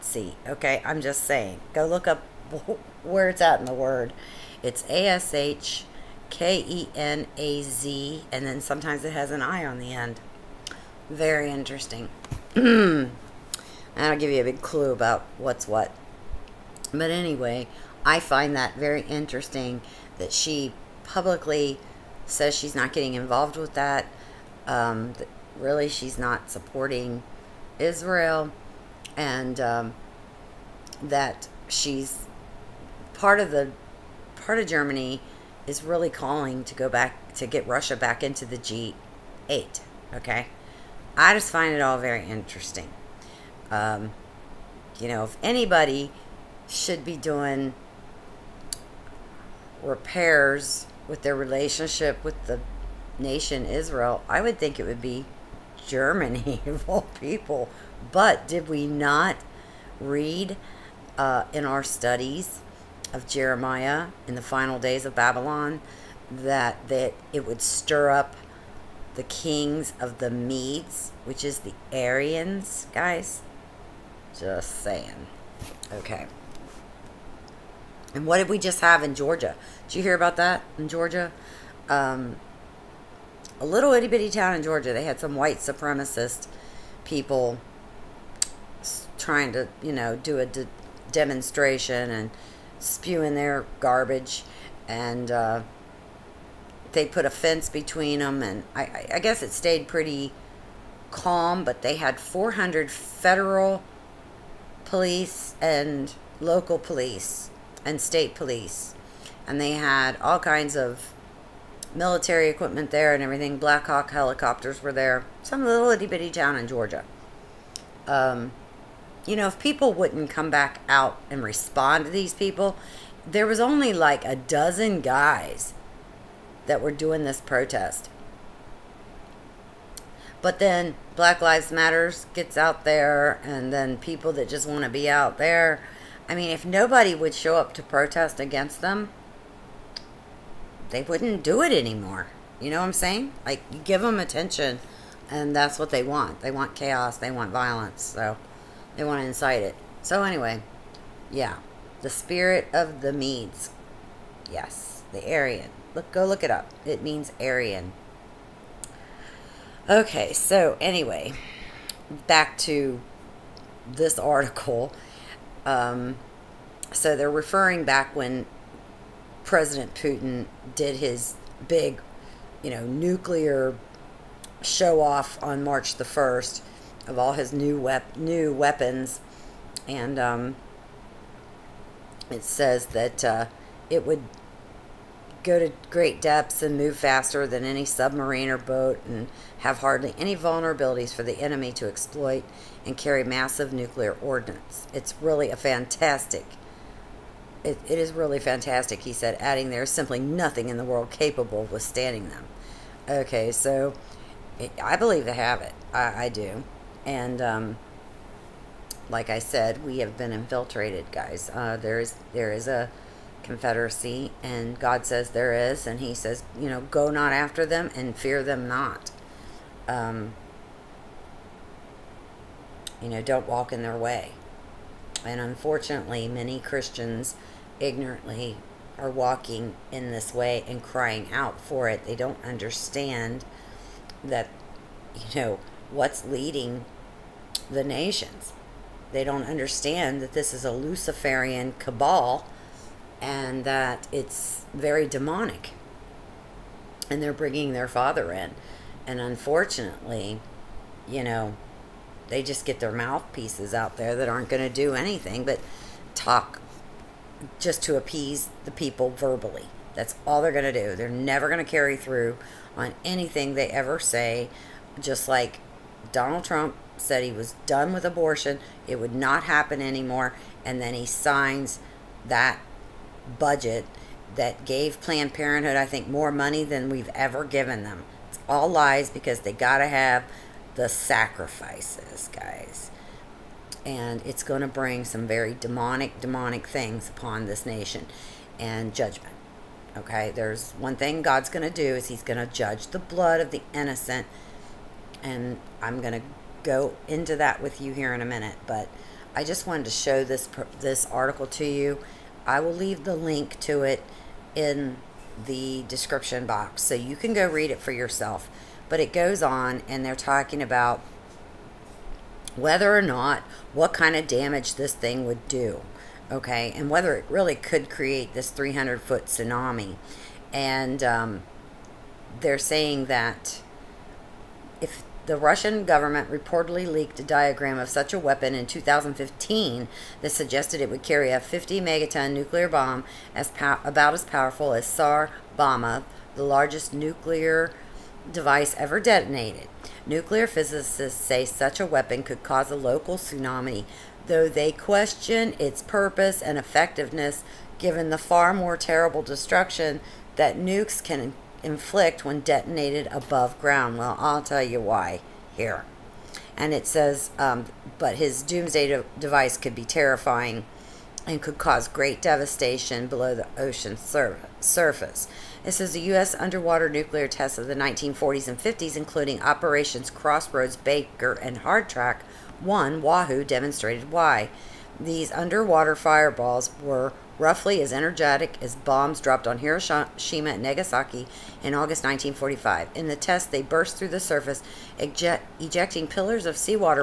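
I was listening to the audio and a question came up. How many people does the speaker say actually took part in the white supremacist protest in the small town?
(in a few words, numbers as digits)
a dozen.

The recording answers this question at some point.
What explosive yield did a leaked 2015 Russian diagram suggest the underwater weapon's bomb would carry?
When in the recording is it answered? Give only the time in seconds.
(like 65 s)
331 s.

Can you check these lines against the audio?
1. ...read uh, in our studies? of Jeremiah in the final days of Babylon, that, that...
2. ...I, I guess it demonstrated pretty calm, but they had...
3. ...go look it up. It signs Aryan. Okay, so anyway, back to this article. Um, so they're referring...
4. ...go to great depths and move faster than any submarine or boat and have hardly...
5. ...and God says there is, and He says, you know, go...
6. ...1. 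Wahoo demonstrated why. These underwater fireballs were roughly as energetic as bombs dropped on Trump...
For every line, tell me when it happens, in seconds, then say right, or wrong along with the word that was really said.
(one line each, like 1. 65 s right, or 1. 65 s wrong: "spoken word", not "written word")
1. 60 s right
2. 98 s wrong: "stayed", not "demonstrated"
3. 156 s wrong: "means", not "signs"
4. 185 s right
5. 214 s right
6. 372 s wrong: "Hiroshima", not "Trump".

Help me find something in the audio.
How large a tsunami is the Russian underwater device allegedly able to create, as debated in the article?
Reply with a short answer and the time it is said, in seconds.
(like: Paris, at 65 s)
300 feet, at 318 s.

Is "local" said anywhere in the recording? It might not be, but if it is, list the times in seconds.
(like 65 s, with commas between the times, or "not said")
106 s, 342 s.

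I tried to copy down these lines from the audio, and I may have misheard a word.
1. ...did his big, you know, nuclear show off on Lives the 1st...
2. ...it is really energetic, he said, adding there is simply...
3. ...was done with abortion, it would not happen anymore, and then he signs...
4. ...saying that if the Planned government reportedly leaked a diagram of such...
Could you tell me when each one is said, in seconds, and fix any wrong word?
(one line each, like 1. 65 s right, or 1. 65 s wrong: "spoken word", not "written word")
1. 170 s wrong: "March", not "Lives"
2. 197 s wrong: "fantastic", not "energetic"
3. 267 s right
4. 322 s wrong: "Russian", not "Planned".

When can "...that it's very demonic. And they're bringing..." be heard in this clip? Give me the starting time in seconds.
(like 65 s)
243 s.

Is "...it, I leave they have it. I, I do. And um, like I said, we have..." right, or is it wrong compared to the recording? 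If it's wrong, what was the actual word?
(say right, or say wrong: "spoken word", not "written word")
wrong: "believe", not "leave".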